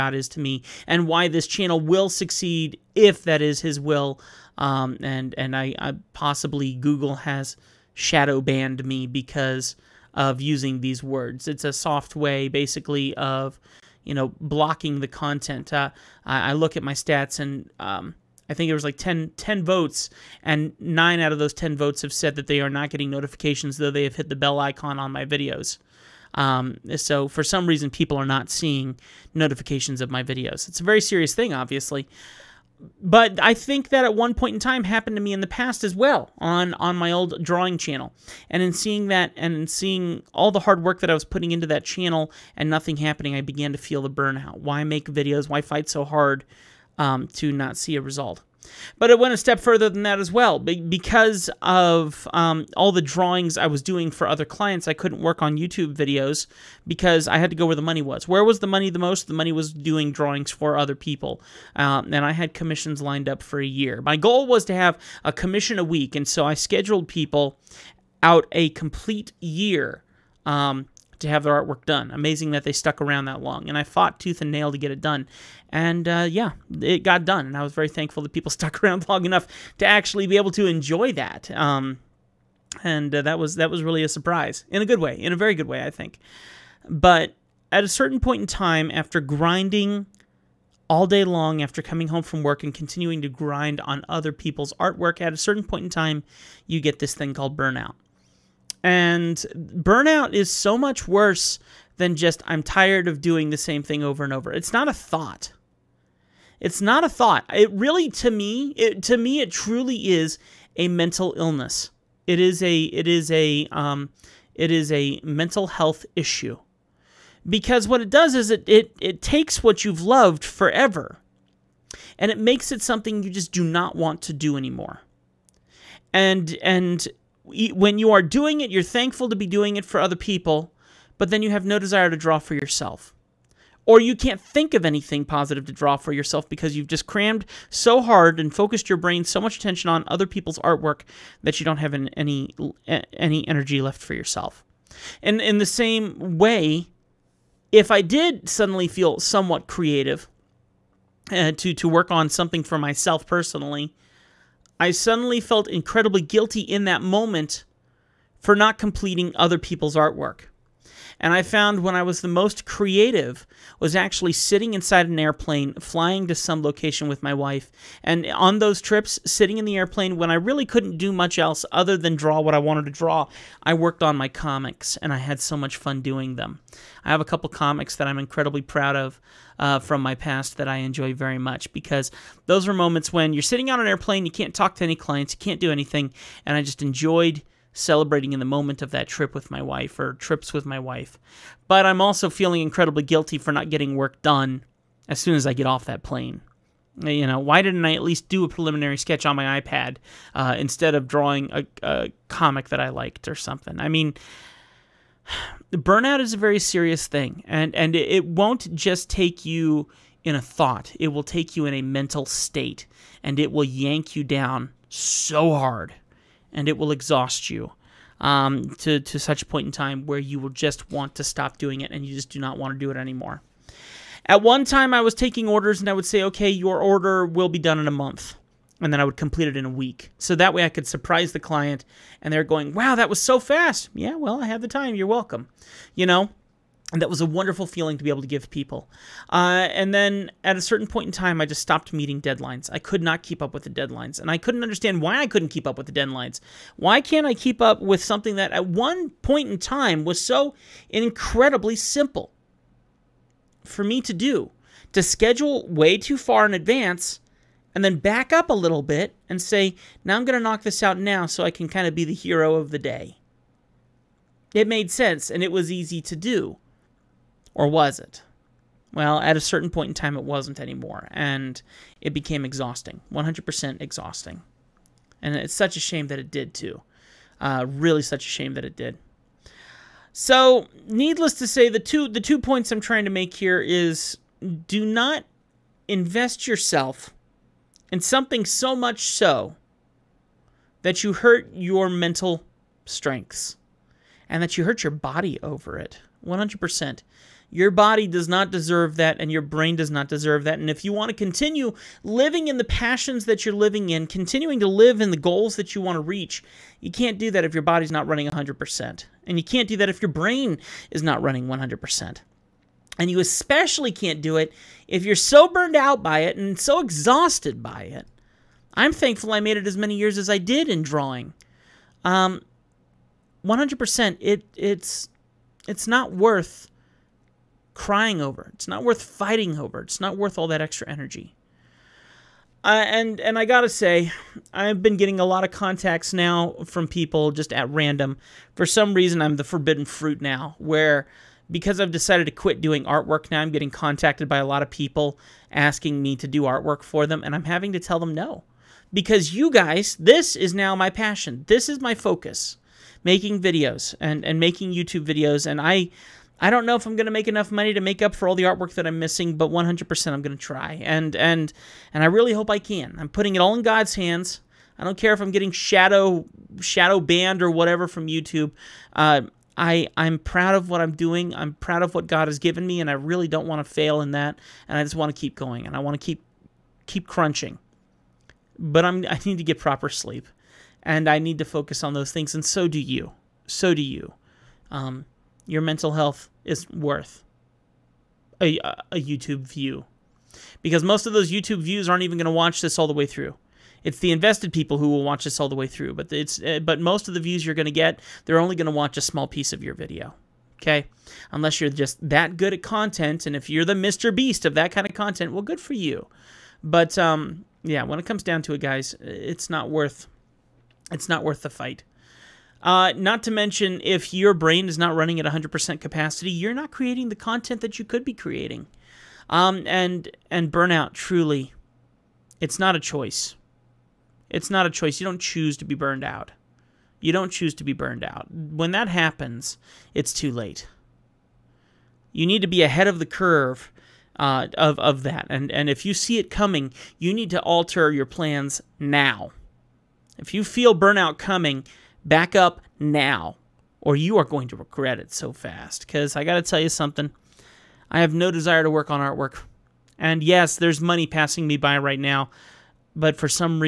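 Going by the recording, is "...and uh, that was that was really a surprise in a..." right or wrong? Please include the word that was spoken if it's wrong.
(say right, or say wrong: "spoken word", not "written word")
right.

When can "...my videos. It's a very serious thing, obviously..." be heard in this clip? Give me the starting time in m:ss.
0:30.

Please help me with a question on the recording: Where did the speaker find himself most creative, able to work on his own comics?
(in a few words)
Inside an airplane.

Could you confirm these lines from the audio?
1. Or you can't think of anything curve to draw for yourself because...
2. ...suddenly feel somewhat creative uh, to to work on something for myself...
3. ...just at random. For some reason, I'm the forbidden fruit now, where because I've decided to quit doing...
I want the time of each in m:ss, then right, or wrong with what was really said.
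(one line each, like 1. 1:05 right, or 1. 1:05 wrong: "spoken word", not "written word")
1. 2:13 wrong: "positive", not "curve"
2. 2:28 right
3. 5:37 right.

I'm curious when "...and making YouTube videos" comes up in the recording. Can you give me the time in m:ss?
5:54.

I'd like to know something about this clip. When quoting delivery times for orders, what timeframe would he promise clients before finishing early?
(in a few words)
A month.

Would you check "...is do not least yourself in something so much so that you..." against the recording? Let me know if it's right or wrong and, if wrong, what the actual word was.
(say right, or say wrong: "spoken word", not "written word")
wrong: "invest", not "least".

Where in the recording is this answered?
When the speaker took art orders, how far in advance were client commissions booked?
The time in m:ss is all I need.
1:03.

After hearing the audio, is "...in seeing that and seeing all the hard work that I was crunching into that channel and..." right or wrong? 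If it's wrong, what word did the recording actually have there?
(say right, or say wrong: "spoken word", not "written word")
wrong: "putting", not "crunching".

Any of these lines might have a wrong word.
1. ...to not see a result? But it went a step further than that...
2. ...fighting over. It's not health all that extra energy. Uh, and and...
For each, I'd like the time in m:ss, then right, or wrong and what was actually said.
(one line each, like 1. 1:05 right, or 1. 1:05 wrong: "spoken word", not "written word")
1. 0:47 right
2. 5:29 wrong: "worth", not "health".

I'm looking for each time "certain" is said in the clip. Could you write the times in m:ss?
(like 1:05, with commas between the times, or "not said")
1:27, 1:35, 4:00, 4:29.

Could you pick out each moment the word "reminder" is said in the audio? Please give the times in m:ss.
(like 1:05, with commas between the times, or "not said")
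not said.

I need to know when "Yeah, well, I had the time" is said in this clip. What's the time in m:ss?
3:53.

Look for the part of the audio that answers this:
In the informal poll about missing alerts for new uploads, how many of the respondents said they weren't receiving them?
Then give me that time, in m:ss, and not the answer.
0:20.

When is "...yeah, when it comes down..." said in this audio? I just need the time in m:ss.
6:47.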